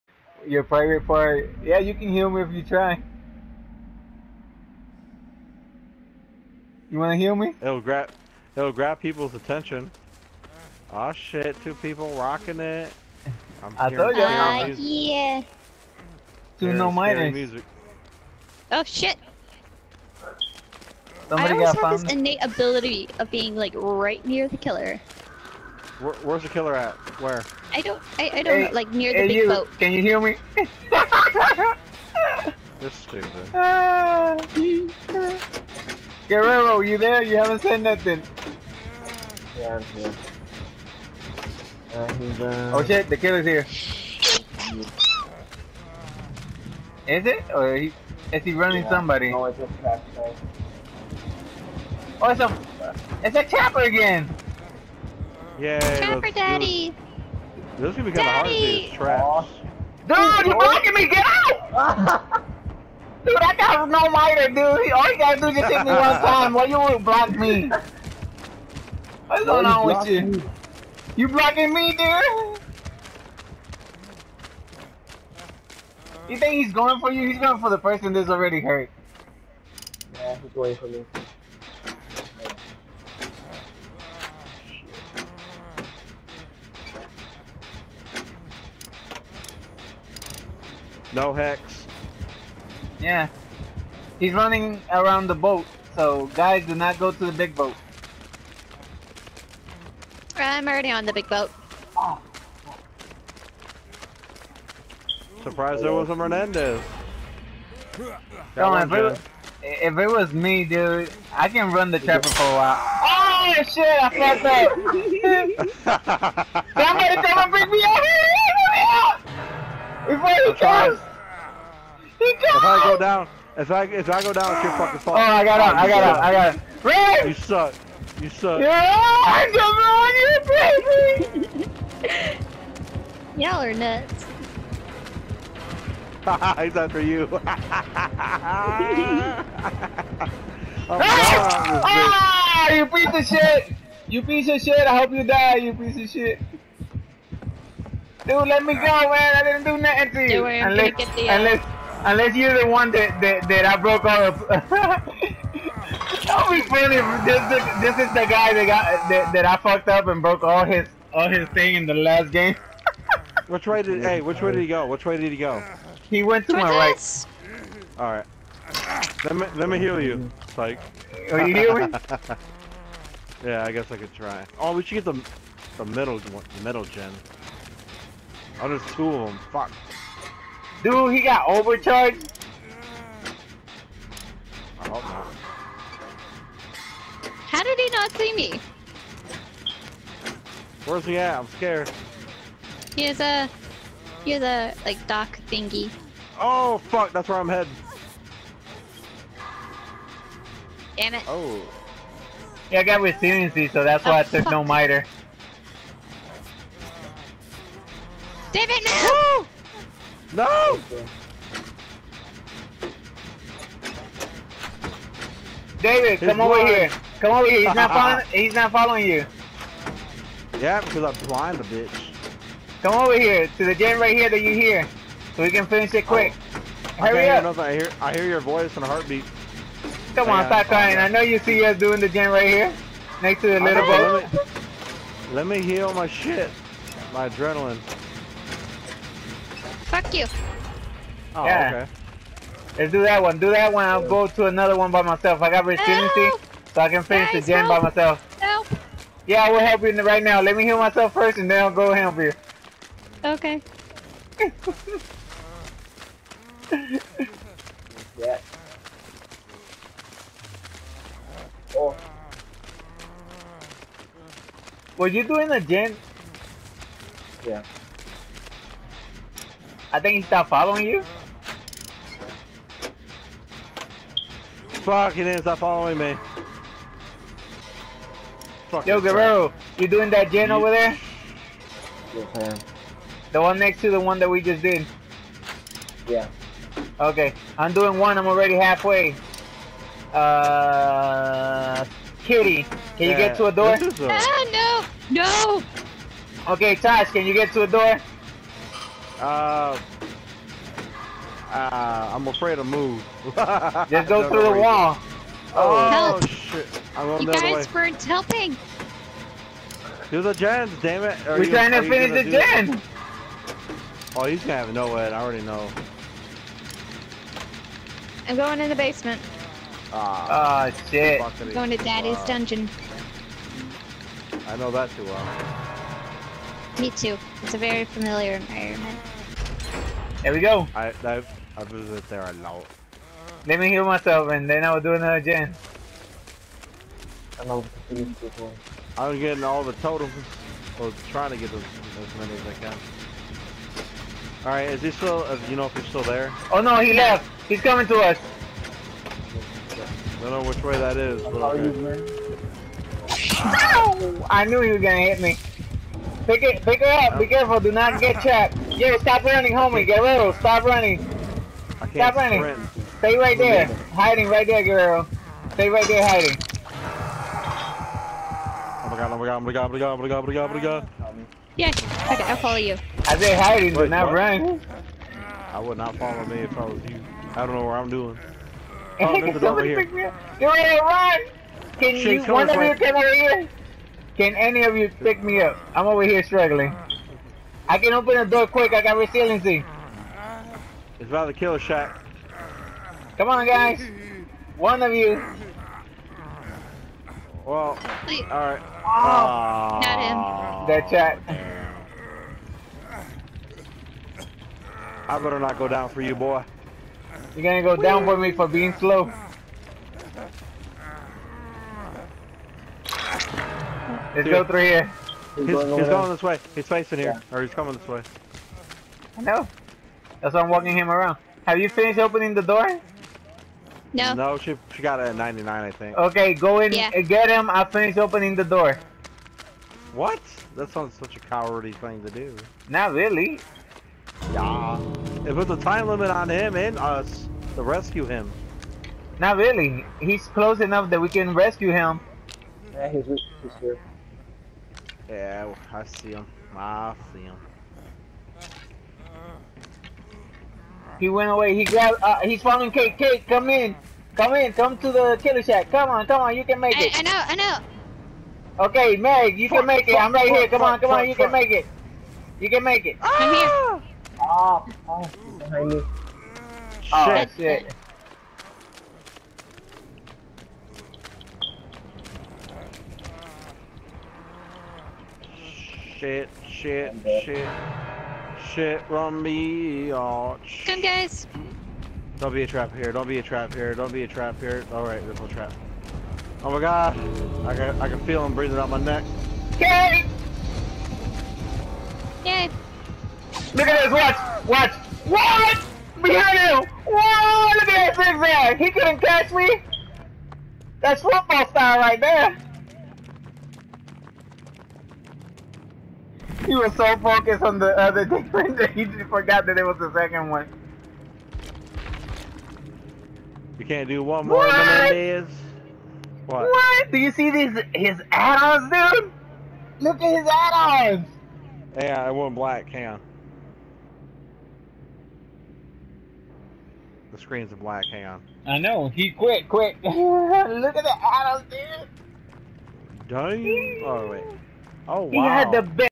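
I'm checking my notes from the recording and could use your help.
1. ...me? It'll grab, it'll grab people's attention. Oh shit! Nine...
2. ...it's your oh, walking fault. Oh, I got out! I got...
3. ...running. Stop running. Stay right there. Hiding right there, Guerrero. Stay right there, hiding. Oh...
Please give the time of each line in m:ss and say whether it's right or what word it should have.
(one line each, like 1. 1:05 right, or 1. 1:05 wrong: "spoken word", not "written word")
1. 0:07 wrong: "Two", not "Nine"
2. 2:04 wrong: "fucking", not "walking"
3. 6:00 right.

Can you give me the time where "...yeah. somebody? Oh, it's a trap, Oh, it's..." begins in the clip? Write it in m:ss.
0:48.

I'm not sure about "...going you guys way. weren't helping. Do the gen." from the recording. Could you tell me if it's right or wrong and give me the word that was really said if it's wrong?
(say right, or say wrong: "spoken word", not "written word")
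right.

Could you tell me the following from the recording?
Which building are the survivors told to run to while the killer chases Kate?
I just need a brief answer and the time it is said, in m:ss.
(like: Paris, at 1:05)
the killer shack, at 7:34.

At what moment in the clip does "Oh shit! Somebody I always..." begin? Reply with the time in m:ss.
0:18.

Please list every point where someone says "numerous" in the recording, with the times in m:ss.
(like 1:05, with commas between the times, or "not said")
not said.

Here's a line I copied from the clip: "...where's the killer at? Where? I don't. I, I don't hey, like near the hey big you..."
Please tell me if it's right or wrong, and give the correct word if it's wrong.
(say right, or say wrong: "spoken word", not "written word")
right.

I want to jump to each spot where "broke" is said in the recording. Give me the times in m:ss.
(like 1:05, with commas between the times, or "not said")
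2:33, 2:40.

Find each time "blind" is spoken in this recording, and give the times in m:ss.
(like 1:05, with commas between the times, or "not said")
3:36, 3:41.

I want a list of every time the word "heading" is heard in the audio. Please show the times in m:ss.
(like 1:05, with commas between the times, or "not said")
3:17.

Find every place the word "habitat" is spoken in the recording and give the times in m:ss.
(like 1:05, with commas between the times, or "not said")
not said.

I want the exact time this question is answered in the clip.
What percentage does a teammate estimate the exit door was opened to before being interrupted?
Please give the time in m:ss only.
7:04.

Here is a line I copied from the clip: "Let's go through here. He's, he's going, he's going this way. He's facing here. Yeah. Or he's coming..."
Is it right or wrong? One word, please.
right.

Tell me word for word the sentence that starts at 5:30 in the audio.
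I I've, I visit there a lot.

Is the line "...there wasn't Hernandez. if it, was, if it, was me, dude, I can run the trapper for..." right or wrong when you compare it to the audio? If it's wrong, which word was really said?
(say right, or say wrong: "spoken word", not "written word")
right.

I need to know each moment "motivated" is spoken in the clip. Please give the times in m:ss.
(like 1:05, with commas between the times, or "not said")
not said.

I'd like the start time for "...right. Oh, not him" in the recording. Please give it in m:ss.
6:38.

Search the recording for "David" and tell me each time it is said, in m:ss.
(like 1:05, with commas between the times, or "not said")
3:28, 3:35.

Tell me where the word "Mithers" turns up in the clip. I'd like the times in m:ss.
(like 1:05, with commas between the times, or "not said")
0:16, 3:24.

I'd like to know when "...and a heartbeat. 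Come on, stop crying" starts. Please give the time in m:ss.
3:48.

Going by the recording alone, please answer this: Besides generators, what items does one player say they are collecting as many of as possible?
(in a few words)
totems.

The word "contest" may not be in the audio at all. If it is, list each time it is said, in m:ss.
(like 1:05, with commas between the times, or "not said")
not said.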